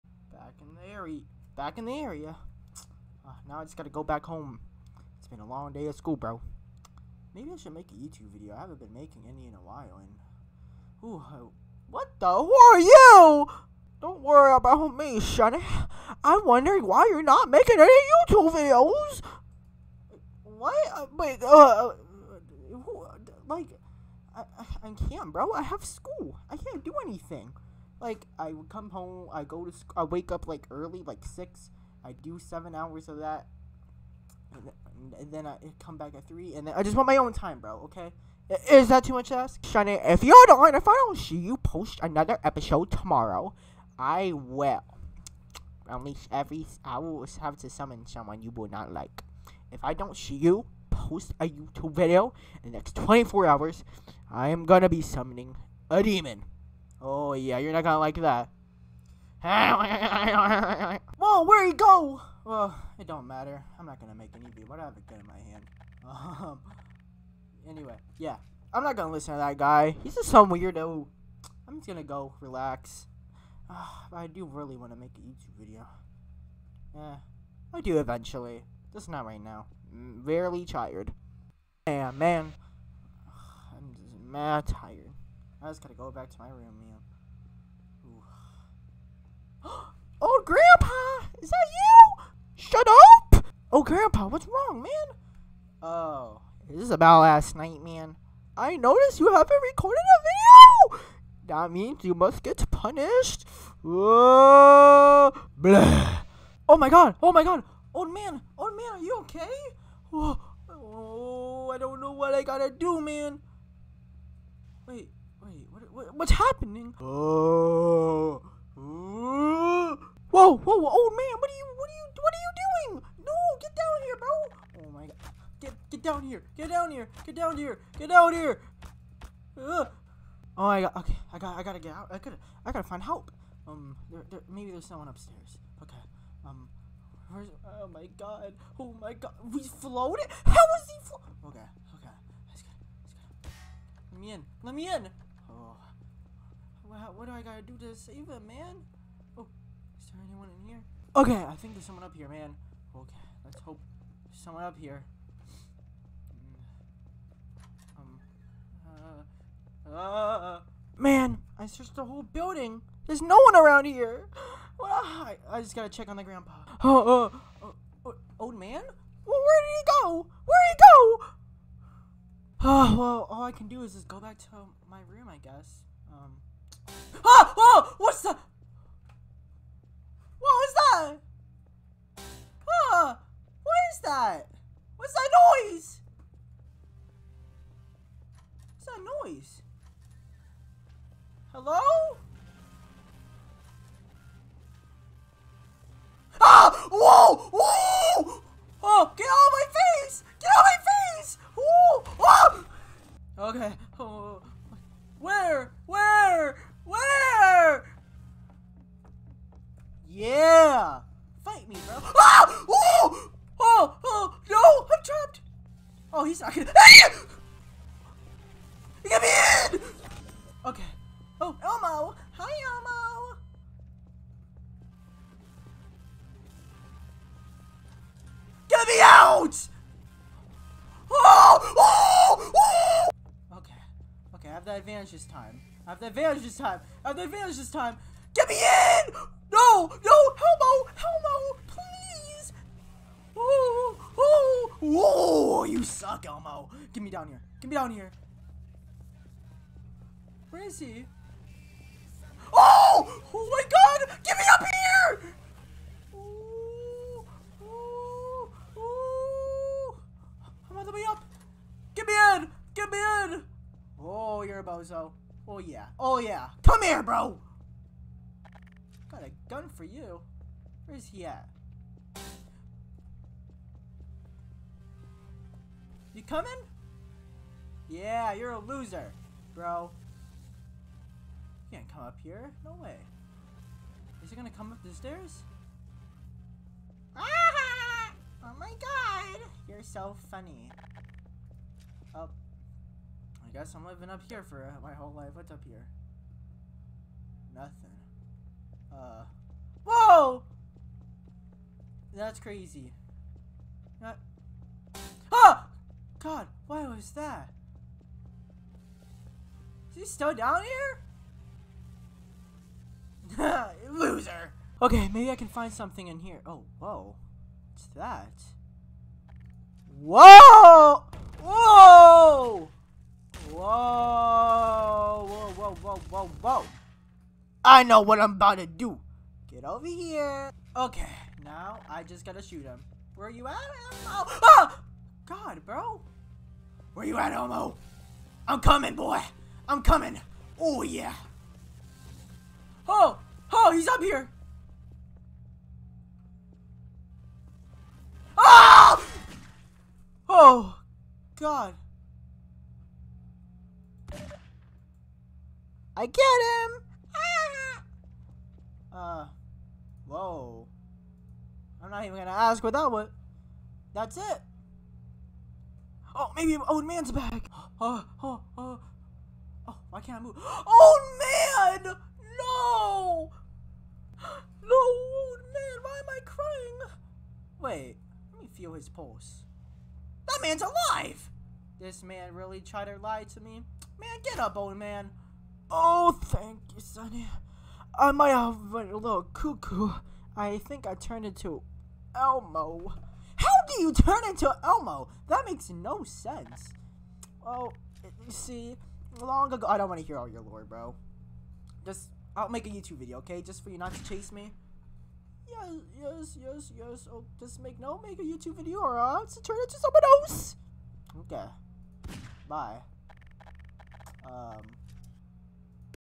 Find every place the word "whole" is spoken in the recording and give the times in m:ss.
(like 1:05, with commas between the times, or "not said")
2:42, 4:54.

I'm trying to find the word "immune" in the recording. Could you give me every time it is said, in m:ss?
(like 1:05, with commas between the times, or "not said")
not said.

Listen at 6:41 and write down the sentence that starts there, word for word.
Just, I'll make a YouTube video, okay?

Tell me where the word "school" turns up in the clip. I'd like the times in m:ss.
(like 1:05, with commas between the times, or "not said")
0:05, 0:25.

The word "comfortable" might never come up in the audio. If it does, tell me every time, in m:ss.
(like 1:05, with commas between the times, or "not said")
not said.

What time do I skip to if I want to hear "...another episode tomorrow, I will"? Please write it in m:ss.
0:42.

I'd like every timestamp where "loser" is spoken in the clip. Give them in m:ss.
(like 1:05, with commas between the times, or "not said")
4:38, 5:13.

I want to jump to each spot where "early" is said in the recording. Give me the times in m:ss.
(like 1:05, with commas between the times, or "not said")
0:30.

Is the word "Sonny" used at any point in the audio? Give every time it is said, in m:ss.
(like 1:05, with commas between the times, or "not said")
0:15, 6:26.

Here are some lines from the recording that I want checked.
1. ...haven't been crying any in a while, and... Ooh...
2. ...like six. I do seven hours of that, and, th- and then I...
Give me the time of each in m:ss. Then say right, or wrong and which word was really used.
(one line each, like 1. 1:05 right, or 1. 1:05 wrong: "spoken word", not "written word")
1. 0:08 wrong: "making", not "crying"
2. 0:31 right.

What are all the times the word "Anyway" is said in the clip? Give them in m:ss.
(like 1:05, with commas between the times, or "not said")
1:07.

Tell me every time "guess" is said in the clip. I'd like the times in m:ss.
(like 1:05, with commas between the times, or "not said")
2:55, 4:53.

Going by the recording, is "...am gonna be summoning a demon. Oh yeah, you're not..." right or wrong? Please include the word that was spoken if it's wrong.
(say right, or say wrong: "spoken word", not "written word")
right.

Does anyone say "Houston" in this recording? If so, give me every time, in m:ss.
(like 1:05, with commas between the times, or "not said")
not said.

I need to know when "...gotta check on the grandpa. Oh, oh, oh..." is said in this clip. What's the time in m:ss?
2:45.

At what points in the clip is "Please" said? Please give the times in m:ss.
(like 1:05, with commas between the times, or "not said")
4:01.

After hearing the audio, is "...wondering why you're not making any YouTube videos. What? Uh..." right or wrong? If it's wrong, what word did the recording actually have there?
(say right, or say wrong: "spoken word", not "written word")
right.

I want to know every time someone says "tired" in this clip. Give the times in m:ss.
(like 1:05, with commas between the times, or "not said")
1:20, 1:24.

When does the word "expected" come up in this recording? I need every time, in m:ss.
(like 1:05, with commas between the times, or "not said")
not said.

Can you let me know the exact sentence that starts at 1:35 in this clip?
Oh, this is about last night, man.